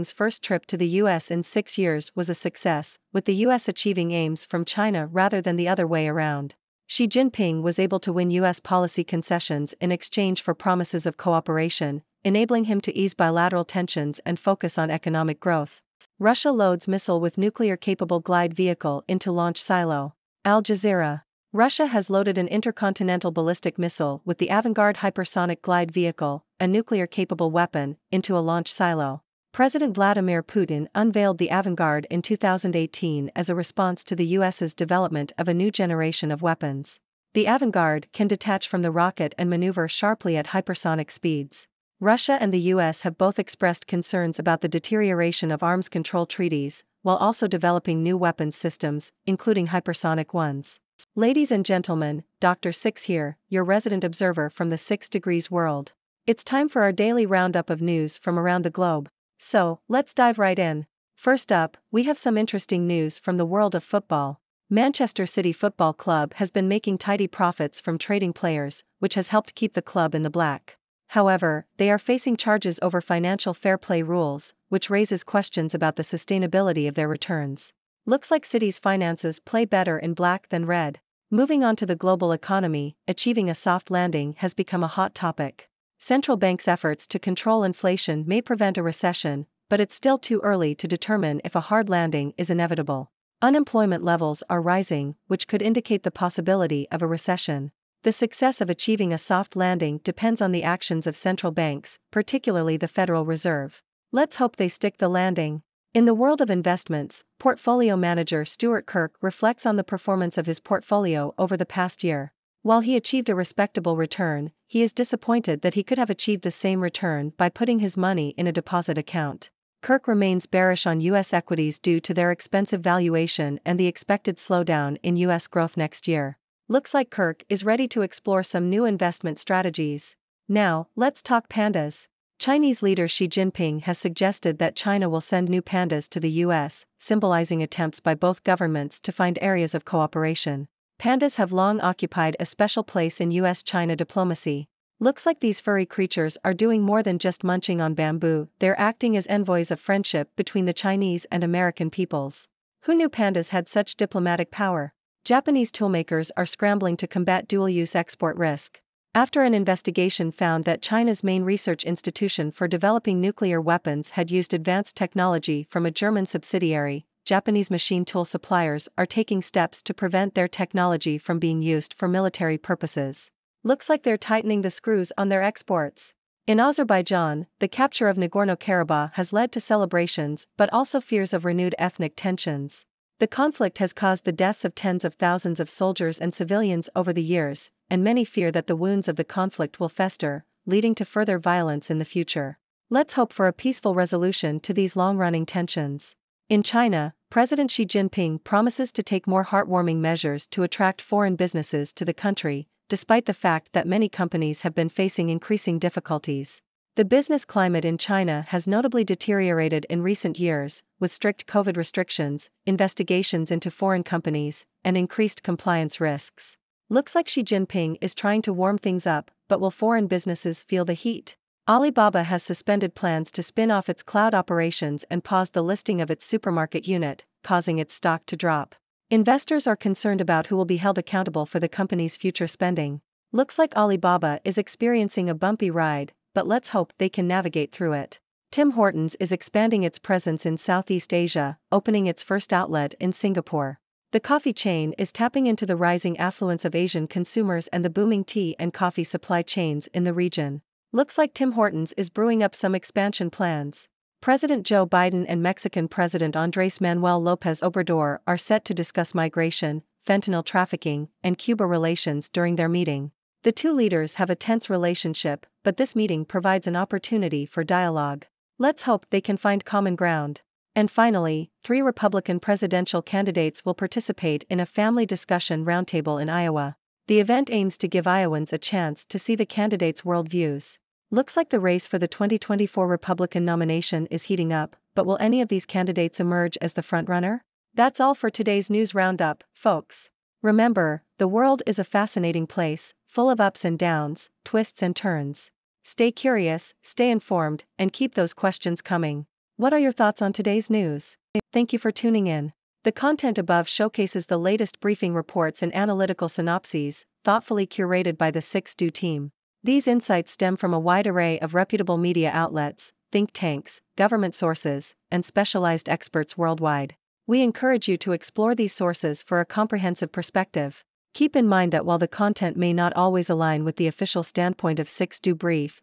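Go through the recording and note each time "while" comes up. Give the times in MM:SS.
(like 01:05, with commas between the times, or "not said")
00:47, 01:52, 05:21.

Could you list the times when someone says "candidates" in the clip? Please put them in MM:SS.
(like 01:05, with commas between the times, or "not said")
04:33, 04:39, 04:45.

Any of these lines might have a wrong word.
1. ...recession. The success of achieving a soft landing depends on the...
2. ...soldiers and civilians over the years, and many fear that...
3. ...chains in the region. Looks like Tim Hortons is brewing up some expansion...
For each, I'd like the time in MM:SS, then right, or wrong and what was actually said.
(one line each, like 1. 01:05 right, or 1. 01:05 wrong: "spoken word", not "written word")
1. 01:37 right
2. 03:05 right
3. 04:09 right.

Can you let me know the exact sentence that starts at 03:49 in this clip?
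Investors are concerned about who will be held accountable for the company's future spending.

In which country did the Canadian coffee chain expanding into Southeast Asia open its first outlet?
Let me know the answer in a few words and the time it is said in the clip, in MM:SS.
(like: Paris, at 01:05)
Singapore, at 04:03.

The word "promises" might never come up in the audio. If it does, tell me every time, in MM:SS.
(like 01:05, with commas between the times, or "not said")
00:10, 03:18.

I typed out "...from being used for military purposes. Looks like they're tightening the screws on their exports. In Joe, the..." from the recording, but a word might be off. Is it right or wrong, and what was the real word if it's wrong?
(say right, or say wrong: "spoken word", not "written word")
wrong: "Azerbaijan", not "Joe".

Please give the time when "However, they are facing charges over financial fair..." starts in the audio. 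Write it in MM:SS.
01:11.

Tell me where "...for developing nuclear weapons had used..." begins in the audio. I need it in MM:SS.
02:42.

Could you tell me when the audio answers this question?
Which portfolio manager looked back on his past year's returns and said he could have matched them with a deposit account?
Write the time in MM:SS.
01:48.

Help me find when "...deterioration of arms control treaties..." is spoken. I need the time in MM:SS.
00:44.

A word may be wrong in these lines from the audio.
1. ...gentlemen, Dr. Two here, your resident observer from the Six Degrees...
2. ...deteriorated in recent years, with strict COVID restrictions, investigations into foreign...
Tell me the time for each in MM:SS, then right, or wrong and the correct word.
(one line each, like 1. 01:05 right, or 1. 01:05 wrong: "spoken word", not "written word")
1. 00:51 wrong: "Six", not "Two"
2. 03:29 right.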